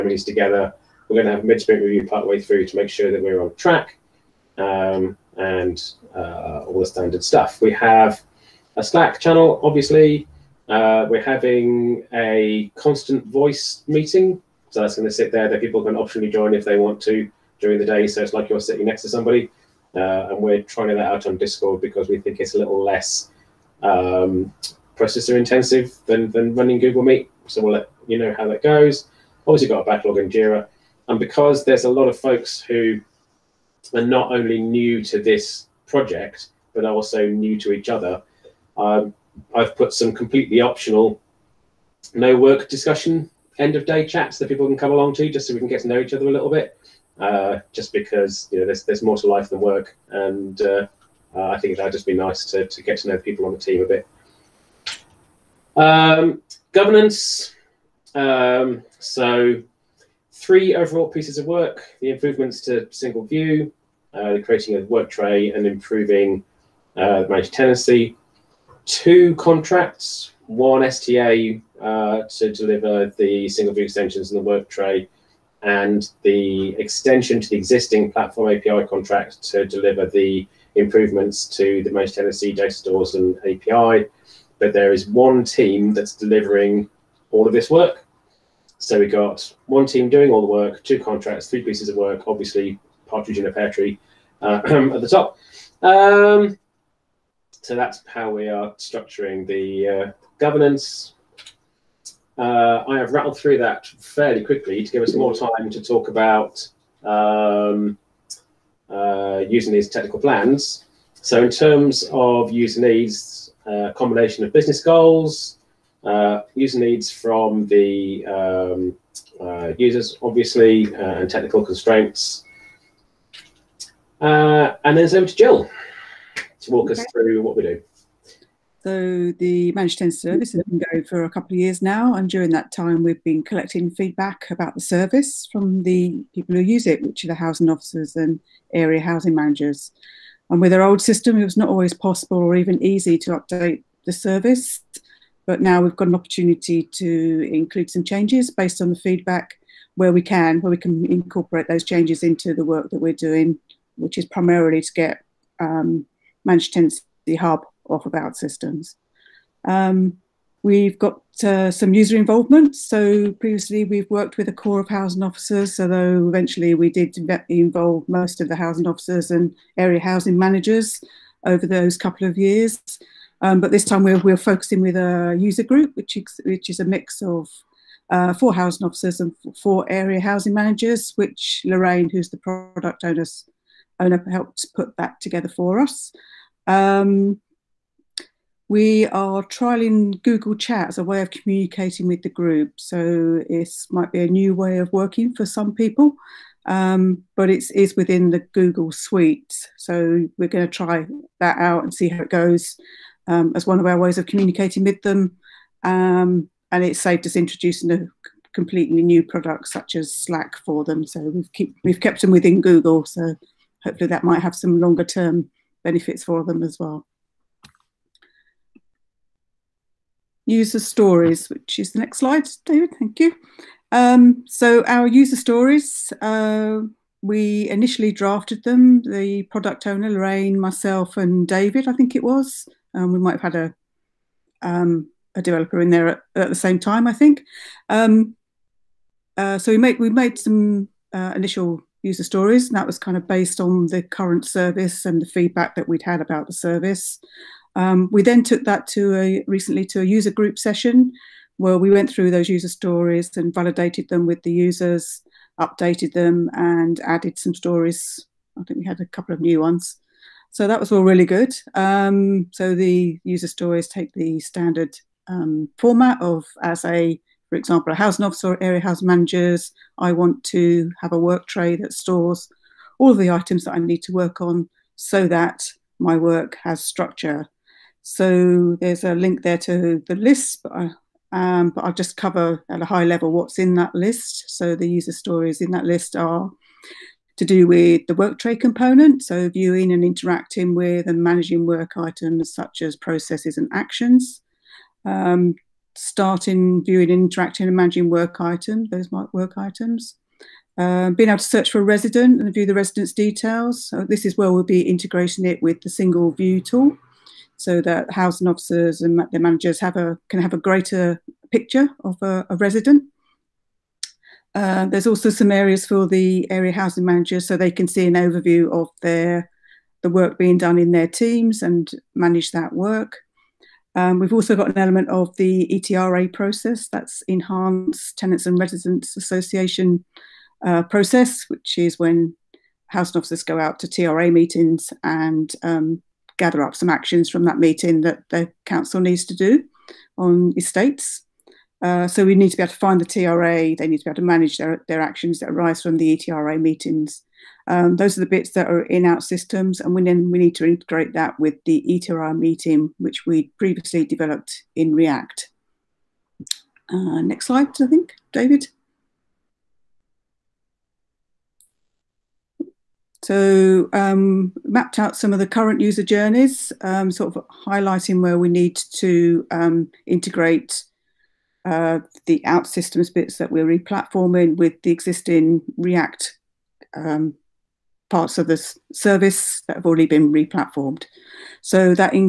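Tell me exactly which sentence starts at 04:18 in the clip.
I think we had a couple of new ones.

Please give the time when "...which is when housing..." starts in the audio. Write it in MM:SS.
05:31.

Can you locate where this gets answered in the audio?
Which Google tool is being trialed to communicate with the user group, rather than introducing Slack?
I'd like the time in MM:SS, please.
03:10.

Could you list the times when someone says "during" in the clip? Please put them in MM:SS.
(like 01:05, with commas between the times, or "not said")
00:17, 02:12.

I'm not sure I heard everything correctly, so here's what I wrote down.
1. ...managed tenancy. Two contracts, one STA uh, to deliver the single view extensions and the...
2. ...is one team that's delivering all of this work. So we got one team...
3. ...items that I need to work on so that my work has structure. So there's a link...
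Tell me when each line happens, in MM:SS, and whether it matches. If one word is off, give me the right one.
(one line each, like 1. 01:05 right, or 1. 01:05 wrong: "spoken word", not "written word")
1. 01:07 right
2. 01:24 right
3. 04:33 right.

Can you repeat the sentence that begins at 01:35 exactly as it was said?
Um, so that's how we are structuring the uh, governance.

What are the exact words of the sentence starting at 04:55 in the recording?
Um, starting viewing and interacting and managing work items, those might work items.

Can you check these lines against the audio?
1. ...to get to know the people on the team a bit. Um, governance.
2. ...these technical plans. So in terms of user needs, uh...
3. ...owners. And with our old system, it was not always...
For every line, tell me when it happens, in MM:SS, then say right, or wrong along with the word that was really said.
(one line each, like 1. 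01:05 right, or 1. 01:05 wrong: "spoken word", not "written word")
1. 00:52 right
2. 01:49 right
3. 02:19 wrong: "managers", not "owners".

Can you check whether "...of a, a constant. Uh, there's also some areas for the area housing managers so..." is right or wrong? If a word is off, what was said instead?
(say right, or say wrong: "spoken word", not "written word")
wrong: "resident", not "constant".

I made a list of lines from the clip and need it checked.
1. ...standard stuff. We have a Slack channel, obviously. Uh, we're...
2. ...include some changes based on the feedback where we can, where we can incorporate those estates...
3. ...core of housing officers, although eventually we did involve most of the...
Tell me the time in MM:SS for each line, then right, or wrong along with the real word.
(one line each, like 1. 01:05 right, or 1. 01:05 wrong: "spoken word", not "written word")
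1. 00:06 right
2. 02:27 wrong: "changes", not "estates"
3. 02:44 right.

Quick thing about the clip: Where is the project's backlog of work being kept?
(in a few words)
Jira.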